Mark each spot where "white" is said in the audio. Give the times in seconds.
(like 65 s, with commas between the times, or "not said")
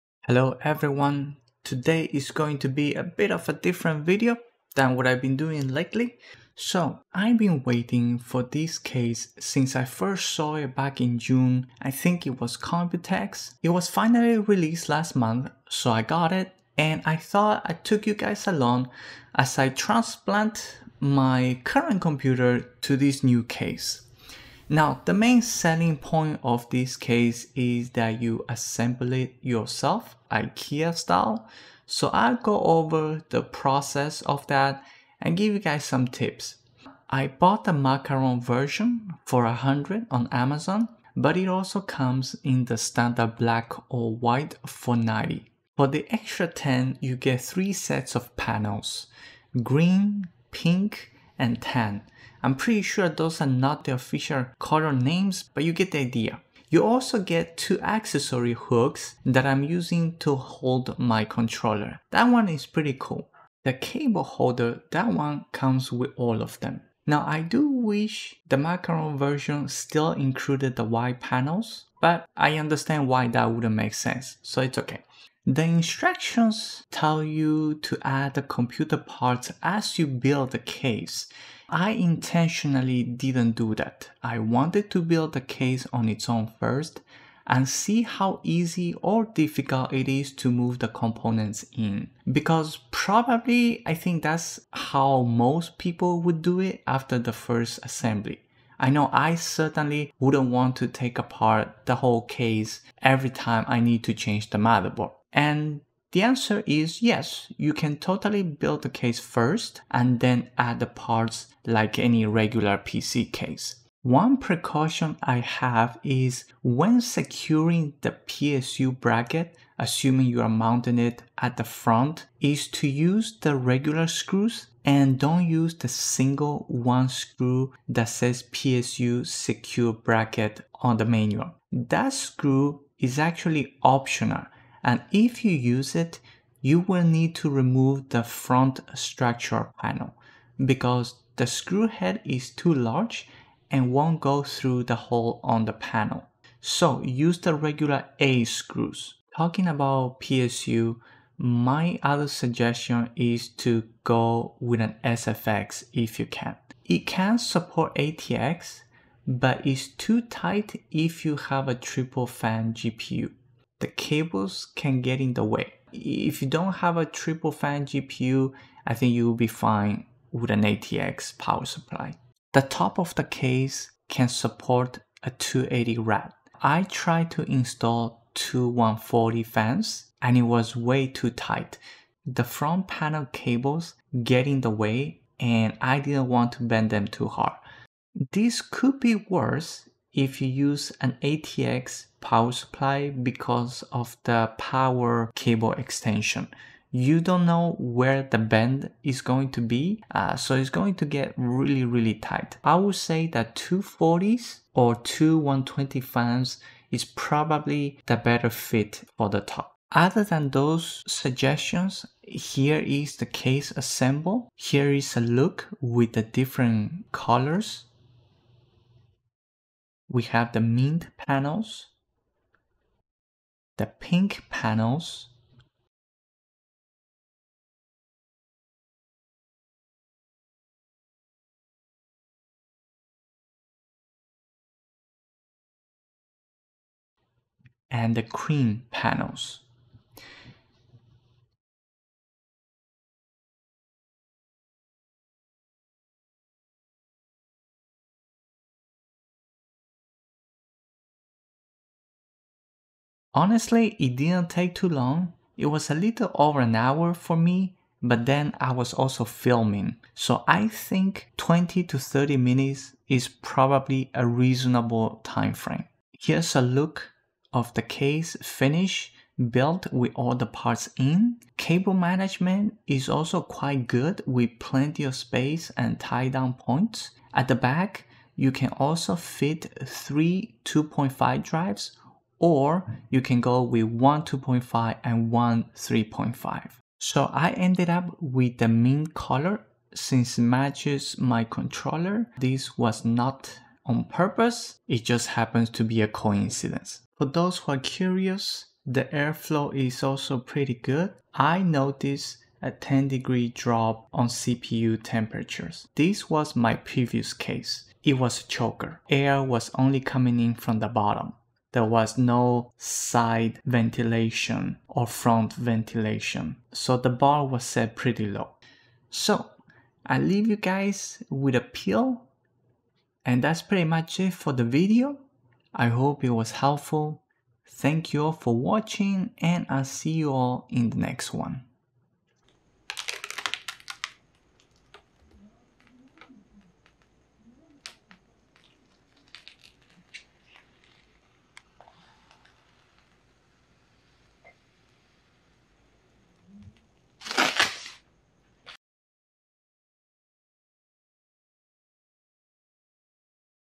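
44 s, 70 s.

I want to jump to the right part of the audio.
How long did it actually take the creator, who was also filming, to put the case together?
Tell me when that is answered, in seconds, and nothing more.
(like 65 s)
255 s.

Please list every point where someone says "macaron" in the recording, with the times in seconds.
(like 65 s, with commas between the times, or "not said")
37 s, 68 s.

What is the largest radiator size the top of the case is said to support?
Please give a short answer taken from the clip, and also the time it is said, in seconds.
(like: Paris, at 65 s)
280, at 175 s.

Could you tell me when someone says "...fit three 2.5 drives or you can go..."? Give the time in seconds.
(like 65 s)
279 s.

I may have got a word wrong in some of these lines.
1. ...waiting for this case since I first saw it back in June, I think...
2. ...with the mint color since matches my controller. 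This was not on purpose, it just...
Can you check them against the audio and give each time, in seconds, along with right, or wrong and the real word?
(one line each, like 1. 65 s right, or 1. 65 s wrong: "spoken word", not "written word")
1. 7 s right
2. 288 s right.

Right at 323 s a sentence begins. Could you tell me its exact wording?
And that's pretty much it for the video.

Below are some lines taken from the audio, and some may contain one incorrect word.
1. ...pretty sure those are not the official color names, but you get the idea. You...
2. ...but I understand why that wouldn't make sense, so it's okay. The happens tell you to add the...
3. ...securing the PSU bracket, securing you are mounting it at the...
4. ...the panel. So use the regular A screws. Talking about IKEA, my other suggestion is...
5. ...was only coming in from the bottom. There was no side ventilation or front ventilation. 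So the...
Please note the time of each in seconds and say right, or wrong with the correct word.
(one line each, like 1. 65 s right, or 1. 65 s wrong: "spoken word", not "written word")
1. 52 s right
2. 71 s wrong: "instructions", not "happens"
3. 117 s wrong: "assuming", not "securing"
4. 145 s wrong: "PSU", not "IKEA"
5. 309 s right.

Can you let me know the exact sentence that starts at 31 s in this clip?
So I'll go over the process of that and give you guys some tips.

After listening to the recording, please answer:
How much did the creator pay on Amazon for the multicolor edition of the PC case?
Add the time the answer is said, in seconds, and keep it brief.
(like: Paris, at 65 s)
100, at 39 s.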